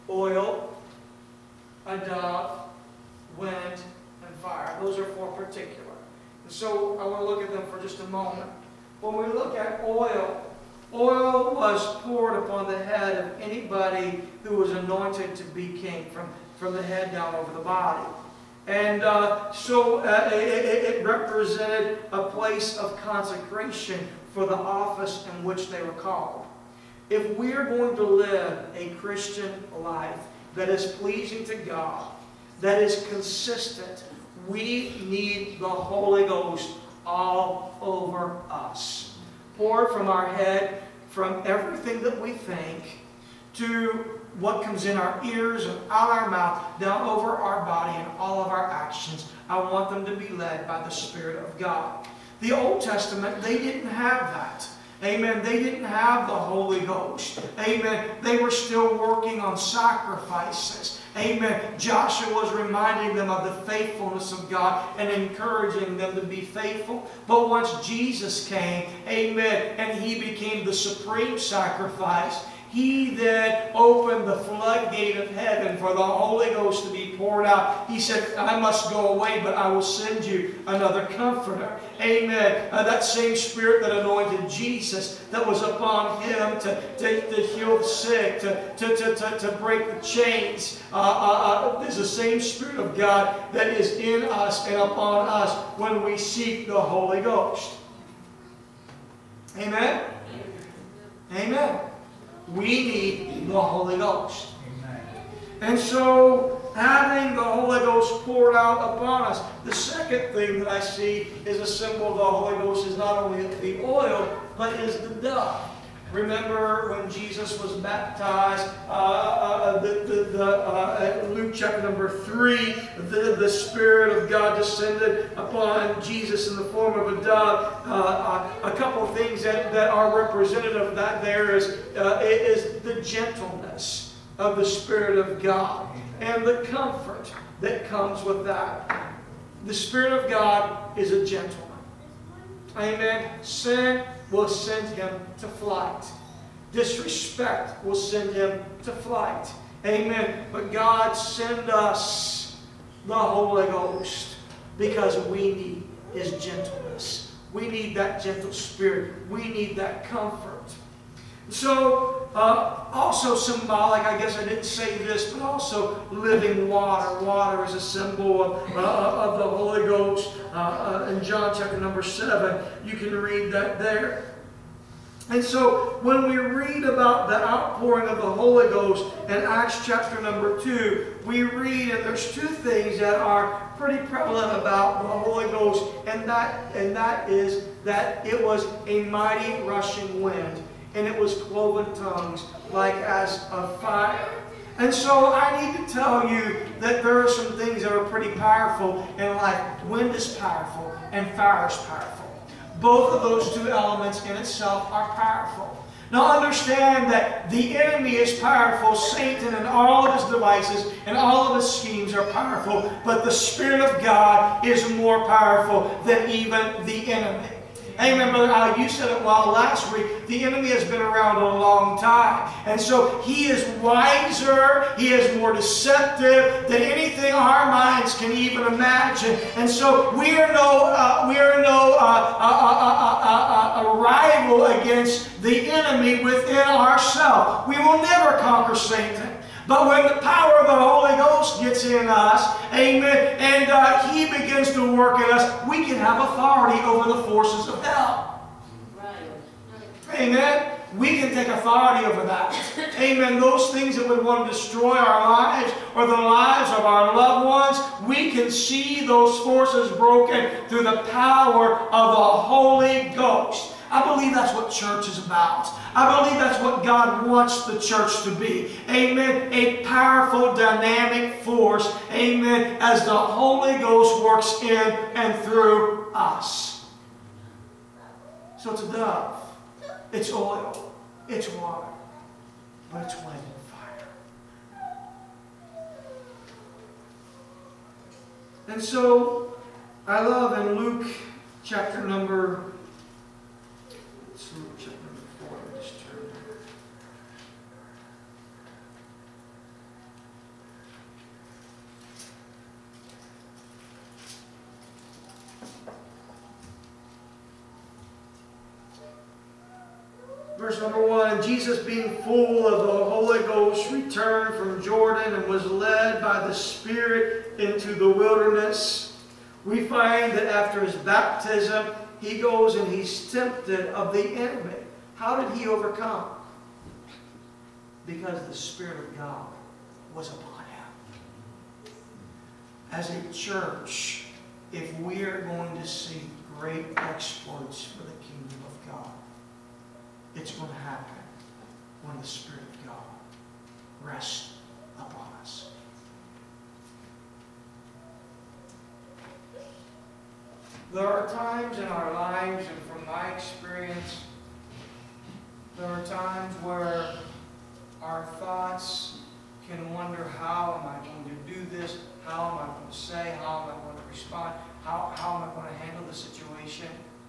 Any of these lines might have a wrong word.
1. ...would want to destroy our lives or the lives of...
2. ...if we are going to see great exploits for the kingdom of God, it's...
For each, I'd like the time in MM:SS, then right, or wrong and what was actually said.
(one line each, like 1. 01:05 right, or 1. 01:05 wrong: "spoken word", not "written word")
1. 04:14 right
2. 05:34 right.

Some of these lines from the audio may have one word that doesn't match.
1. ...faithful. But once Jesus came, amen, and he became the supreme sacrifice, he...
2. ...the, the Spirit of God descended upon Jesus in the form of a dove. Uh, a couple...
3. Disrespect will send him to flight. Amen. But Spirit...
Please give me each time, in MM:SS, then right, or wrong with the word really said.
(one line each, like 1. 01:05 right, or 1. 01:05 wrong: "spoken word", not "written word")
1. 01:06 right
2. 02:03 right
3. 02:26 wrong: "God", not "Spirit".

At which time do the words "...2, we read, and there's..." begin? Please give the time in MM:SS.
03:00.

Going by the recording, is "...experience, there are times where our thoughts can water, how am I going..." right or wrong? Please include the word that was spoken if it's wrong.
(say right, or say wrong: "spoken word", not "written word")
wrong: "wonder", not "water".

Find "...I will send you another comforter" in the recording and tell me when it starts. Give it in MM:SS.
01:19.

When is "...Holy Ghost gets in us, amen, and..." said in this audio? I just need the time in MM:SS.
04:00.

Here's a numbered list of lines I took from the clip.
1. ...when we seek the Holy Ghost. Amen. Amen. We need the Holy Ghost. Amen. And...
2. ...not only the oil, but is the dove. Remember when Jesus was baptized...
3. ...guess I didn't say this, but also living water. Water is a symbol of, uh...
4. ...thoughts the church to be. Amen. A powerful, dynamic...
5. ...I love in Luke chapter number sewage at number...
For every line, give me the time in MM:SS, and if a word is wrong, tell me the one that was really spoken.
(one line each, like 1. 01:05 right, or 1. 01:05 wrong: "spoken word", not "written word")
1. 01:35 right
2. 01:52 right
3. 02:44 right
4. 04:27 wrong: "wants", not "thoughts"
5. 04:50 right.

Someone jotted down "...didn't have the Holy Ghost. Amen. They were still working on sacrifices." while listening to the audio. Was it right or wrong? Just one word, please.
right.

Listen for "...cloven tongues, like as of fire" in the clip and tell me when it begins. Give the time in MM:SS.
03:11.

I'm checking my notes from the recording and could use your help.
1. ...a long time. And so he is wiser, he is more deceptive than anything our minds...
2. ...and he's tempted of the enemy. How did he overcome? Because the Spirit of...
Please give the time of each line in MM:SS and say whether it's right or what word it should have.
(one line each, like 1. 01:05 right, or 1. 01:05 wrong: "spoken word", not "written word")
1. 03:41 right
2. 05:22 right.